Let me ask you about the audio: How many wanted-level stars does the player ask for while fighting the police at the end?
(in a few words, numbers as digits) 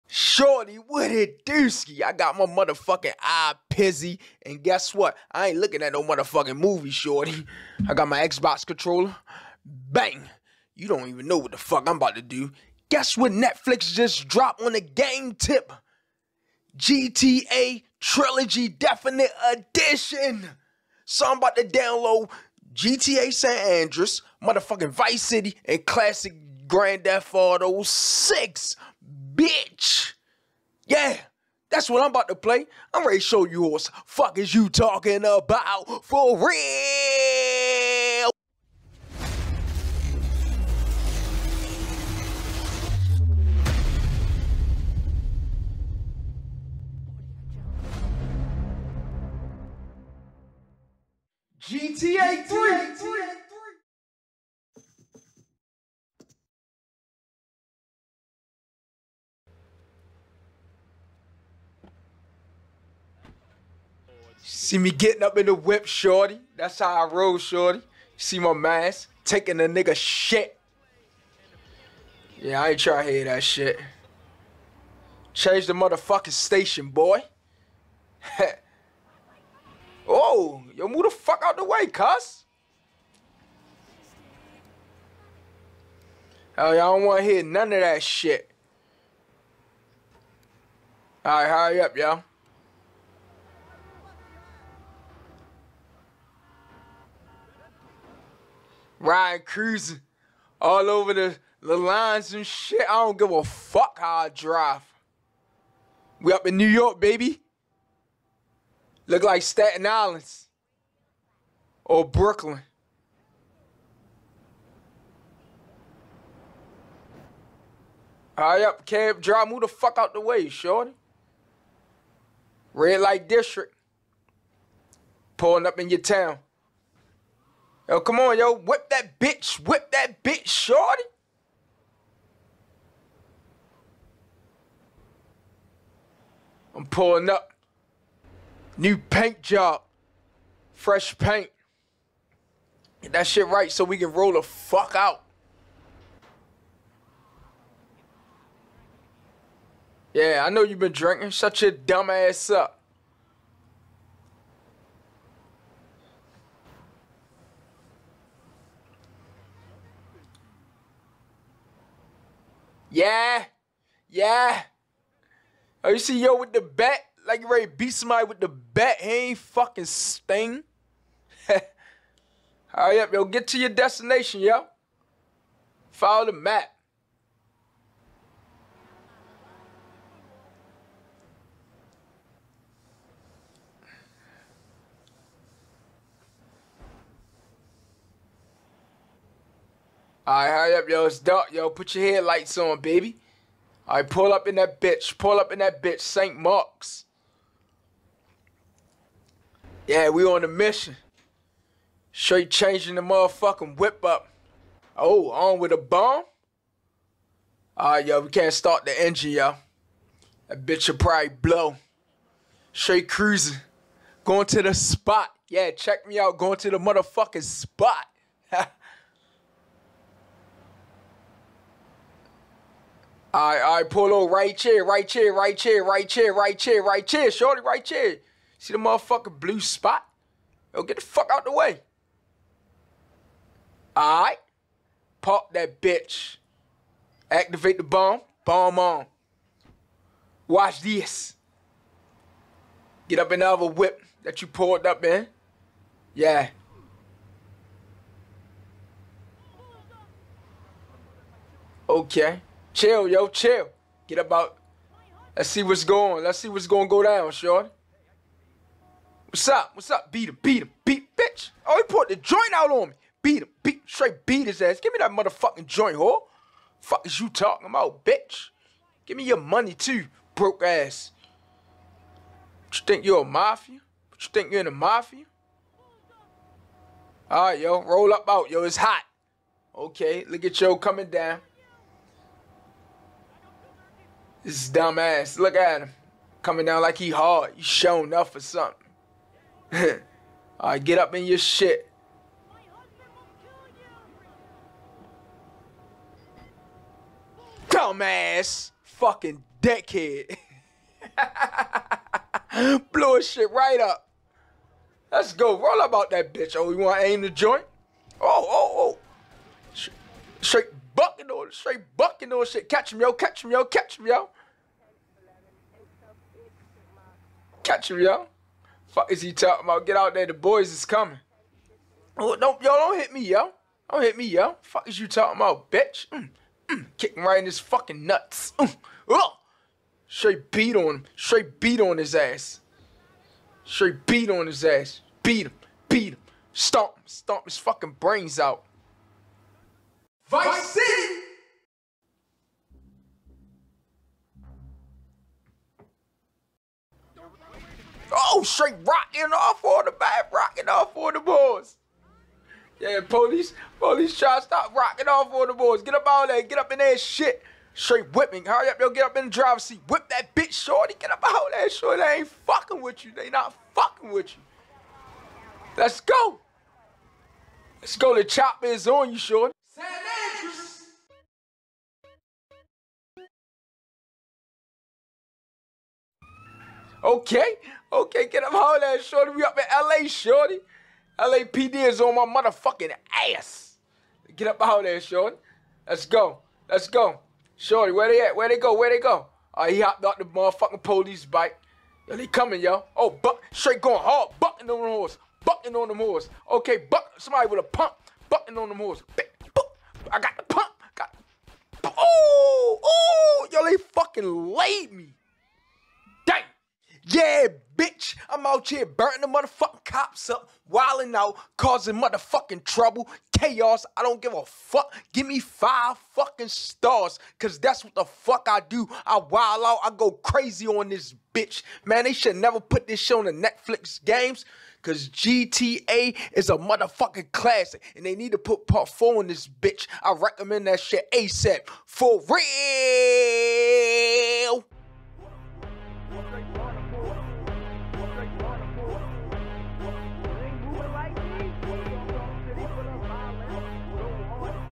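5.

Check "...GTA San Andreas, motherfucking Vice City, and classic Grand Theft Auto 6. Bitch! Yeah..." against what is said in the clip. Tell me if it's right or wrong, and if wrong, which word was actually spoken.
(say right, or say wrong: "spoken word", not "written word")
right.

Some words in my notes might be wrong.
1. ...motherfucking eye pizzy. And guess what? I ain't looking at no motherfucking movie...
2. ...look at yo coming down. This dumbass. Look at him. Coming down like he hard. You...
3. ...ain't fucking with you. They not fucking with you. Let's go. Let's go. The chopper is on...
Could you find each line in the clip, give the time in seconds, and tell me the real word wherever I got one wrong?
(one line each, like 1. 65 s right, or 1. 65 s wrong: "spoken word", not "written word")
1. 2 s right
2. 280 s right
3. 362 s right.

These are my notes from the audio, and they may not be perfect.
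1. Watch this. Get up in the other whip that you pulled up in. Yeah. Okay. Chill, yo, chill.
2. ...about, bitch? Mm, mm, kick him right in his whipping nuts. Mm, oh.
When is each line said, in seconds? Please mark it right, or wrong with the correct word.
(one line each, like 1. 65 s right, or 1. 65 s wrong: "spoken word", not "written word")
1. 240 s right
2. 325 s wrong: "fucking", not "whipping".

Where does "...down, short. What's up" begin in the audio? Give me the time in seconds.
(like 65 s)
257 s.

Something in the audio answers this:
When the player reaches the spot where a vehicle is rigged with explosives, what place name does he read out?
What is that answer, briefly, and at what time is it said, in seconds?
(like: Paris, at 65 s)
St. Mark's, at 195 s.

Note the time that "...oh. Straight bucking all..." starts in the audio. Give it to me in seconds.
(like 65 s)
309 s.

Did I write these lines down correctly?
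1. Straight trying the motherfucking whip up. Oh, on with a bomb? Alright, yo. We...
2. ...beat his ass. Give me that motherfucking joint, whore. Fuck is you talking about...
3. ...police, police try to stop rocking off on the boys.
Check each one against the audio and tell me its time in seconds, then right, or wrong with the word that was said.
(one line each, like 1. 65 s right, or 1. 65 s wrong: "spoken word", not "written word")
1. 202 s wrong: "changing", not "trying"
2. 264 s right
3. 353 s right.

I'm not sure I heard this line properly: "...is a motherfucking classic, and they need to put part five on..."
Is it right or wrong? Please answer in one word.
wrong.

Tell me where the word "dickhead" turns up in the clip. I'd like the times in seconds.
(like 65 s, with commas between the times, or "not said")
299 s.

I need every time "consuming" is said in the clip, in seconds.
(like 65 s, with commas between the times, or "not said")
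not said.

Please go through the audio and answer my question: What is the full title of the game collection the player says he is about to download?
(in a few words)
GTA Trilogy Definite Edition.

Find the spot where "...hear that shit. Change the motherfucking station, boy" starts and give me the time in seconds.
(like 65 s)
73 s.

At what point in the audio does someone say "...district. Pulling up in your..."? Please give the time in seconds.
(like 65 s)
123 s.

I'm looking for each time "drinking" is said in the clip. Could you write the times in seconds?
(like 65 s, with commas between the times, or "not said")
150 s.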